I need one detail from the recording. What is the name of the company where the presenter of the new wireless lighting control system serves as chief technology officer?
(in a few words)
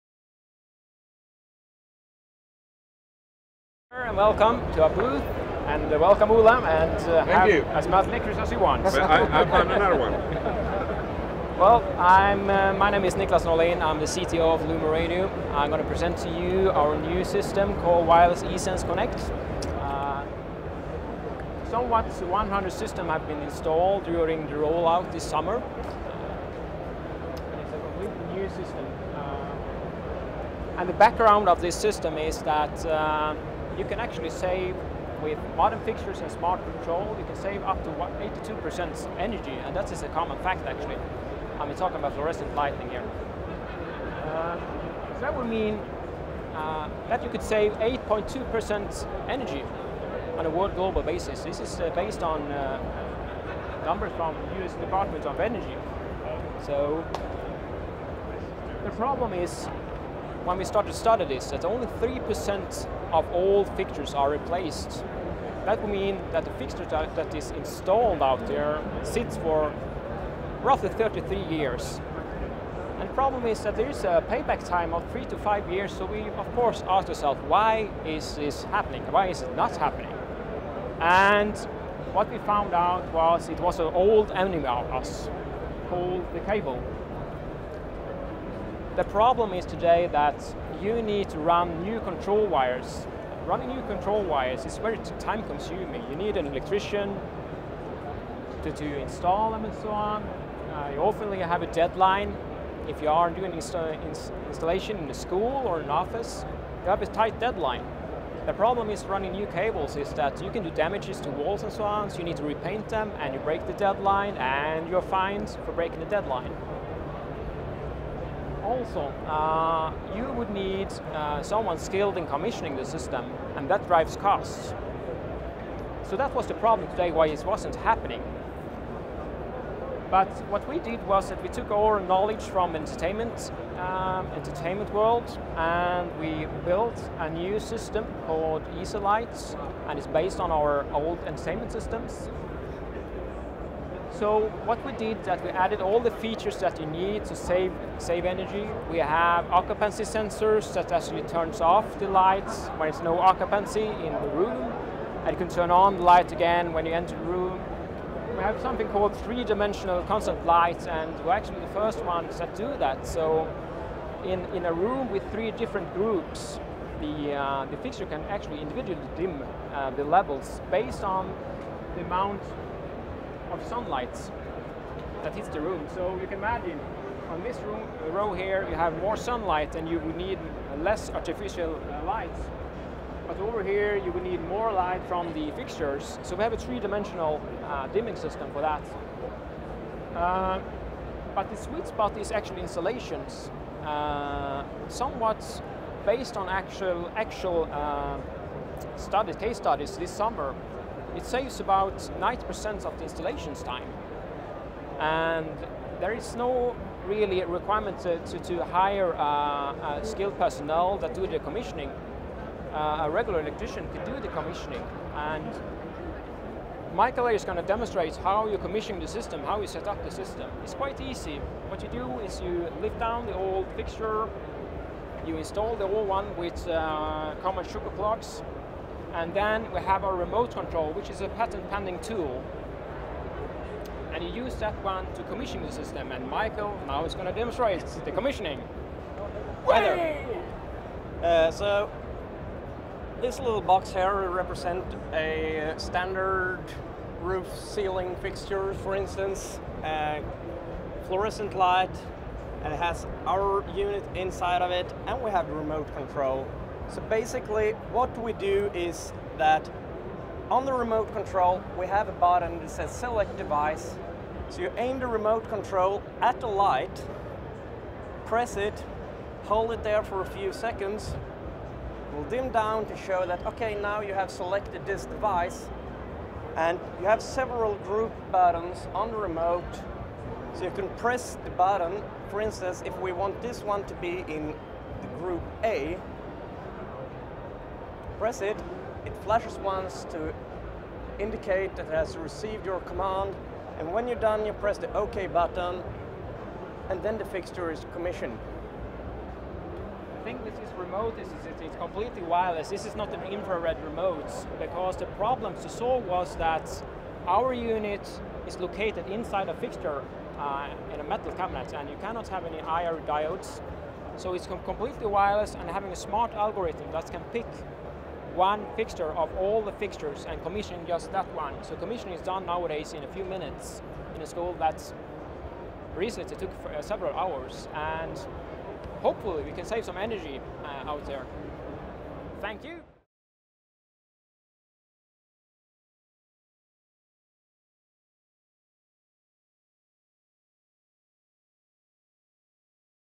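LumenRadio.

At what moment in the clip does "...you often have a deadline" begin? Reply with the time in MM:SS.
01:40.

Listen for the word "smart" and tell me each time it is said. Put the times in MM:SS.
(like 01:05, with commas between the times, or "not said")
00:36, 05:15.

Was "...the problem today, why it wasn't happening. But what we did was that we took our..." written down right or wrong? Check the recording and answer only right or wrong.
right.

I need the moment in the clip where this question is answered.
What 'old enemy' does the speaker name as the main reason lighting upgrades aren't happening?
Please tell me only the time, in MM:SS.
01:26.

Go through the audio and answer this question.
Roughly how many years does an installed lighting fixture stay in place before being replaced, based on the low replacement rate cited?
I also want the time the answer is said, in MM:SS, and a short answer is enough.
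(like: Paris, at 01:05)
33 years, at 01:10.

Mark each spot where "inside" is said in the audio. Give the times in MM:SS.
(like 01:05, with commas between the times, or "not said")
04:14, 05:09.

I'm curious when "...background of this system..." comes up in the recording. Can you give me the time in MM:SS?
00:30.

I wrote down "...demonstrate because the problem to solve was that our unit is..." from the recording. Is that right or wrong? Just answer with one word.
wrong.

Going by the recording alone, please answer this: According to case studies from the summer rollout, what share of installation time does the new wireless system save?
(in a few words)
90%.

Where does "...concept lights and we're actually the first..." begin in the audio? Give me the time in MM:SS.
02:40.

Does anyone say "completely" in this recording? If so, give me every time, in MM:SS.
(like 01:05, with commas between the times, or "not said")
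00:27, 05:01, 05:14.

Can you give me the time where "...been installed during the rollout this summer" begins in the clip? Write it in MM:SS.
00:23.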